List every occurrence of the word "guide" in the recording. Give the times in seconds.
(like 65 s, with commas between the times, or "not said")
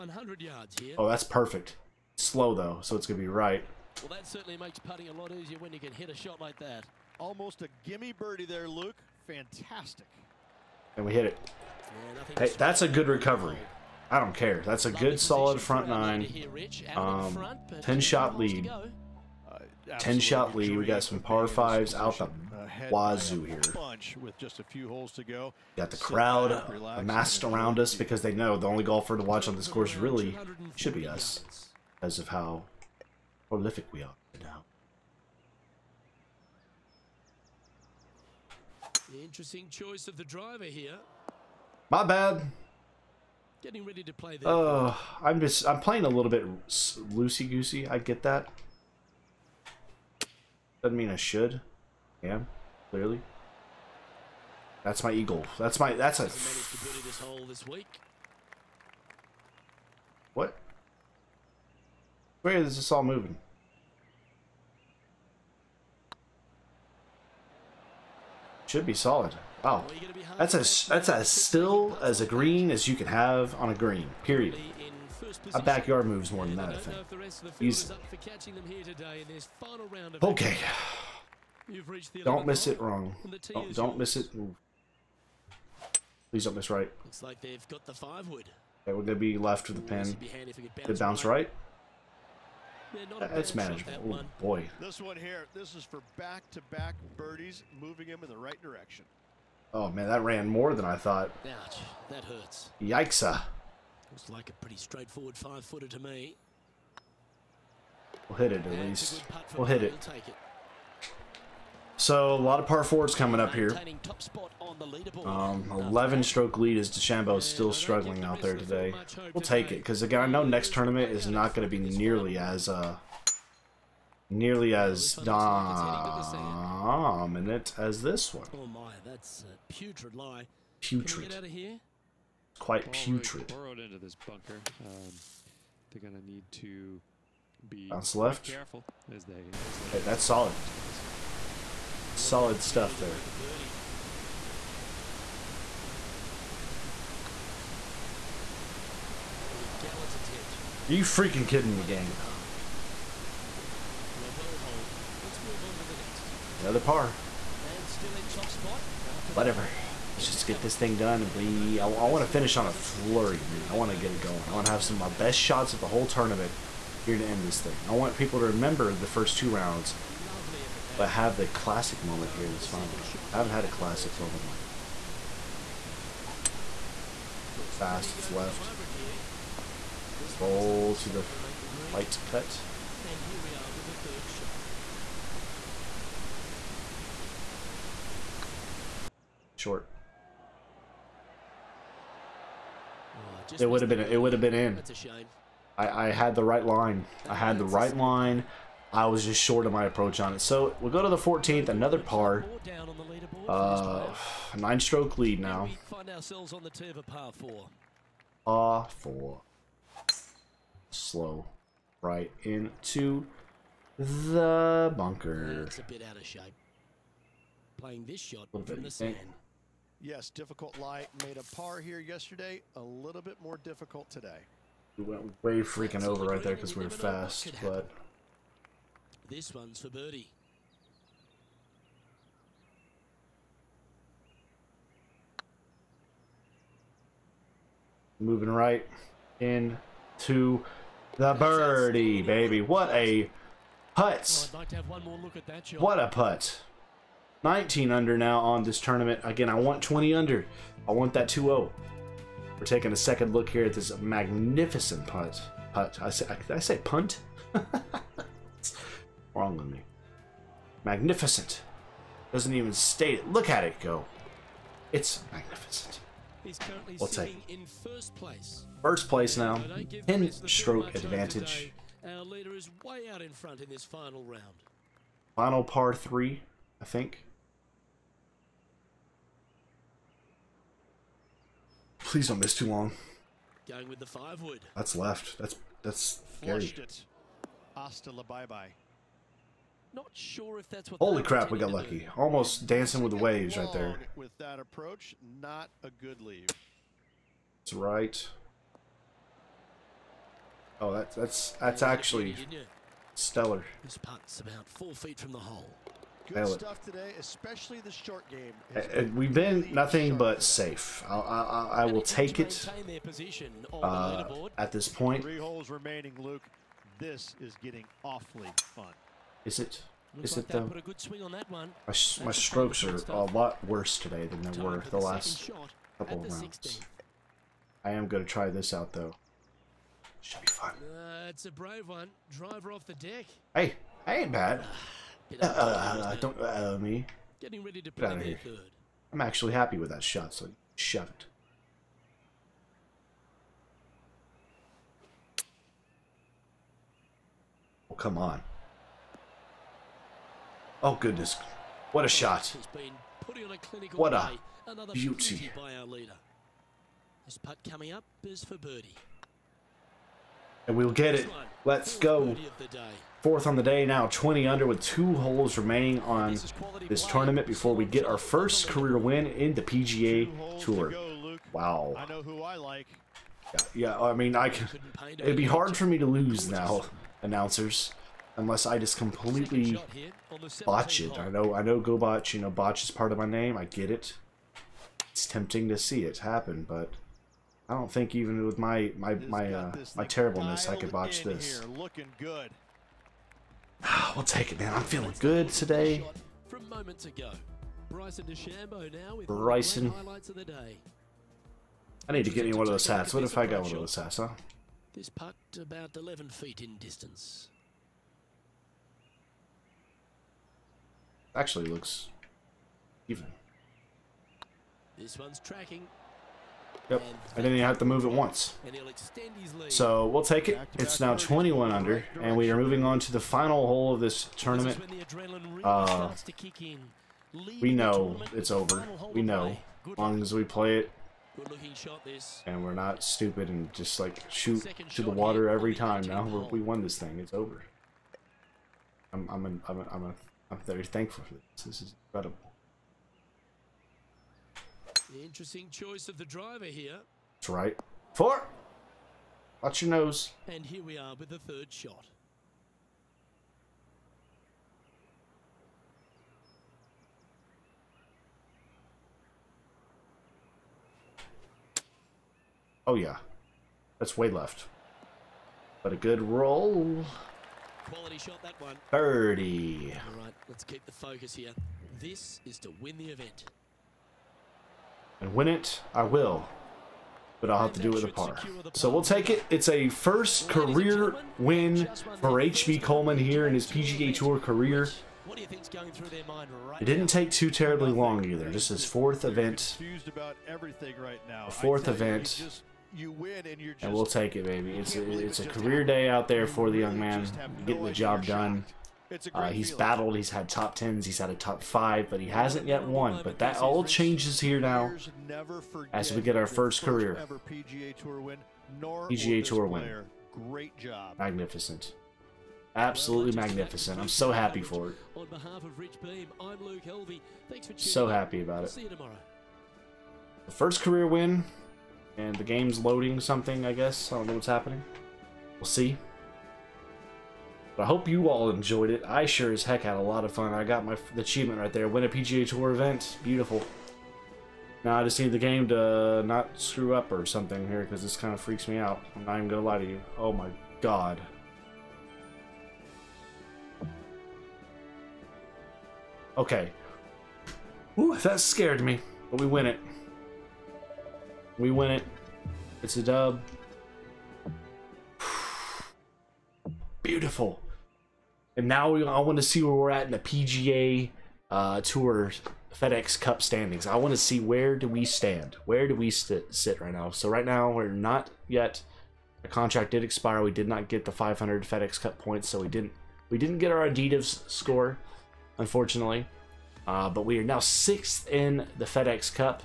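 not said.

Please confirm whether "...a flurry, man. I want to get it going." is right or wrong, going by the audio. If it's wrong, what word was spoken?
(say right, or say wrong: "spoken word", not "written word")
right.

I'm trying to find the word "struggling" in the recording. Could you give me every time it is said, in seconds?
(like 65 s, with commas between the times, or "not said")
117 s.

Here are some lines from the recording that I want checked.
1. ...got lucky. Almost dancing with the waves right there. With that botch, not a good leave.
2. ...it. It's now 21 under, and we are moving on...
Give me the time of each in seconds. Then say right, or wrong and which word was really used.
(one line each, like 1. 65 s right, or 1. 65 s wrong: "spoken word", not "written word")
1. 291 s wrong: "approach", not "botch"
2. 420 s right.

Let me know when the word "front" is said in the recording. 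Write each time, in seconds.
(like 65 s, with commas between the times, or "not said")
15 s, 273 s.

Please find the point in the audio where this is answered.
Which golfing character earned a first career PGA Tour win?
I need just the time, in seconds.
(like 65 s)
482 s.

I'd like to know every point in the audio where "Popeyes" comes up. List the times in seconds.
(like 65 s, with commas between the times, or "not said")
not said.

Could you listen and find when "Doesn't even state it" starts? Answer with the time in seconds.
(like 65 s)
262 s.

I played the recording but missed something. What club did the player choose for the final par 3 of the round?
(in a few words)
five wood.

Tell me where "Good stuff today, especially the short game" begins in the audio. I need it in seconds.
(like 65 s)
306 s.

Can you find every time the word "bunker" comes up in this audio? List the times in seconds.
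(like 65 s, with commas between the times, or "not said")
134 s, 214 s.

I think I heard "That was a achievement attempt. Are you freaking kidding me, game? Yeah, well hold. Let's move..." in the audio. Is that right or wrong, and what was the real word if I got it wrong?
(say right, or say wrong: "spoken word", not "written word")
wrong: "gallant", not "achievement".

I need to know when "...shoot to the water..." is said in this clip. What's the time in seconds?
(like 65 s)
434 s.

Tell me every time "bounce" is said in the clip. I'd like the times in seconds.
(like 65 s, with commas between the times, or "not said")
90 s, 137 s.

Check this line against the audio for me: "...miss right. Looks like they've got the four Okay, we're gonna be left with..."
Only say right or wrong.
wrong.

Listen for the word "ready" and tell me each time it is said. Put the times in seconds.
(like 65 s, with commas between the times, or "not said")
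43 s, 337 s.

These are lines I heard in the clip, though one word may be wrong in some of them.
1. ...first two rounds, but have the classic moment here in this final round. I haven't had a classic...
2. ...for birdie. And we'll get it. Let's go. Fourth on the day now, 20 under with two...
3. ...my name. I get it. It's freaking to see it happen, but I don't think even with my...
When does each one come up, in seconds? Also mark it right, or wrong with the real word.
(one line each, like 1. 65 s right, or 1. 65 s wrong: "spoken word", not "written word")
1. 169 s right
2. 358 s right
3. 383 s wrong: "tempting", not "freaking".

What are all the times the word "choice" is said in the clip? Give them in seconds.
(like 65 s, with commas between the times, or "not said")
39 s, 445 s.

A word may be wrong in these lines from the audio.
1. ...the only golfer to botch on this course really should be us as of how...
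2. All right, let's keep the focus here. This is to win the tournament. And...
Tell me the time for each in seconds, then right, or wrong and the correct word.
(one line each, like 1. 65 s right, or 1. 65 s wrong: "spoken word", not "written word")
1. 28 s wrong: "watch", not "botch"
2. 470 s wrong: "event", not "tournament".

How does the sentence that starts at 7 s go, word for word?
Almost a gimme birdie there, Luke.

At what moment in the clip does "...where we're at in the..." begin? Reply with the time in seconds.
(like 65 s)
559 s.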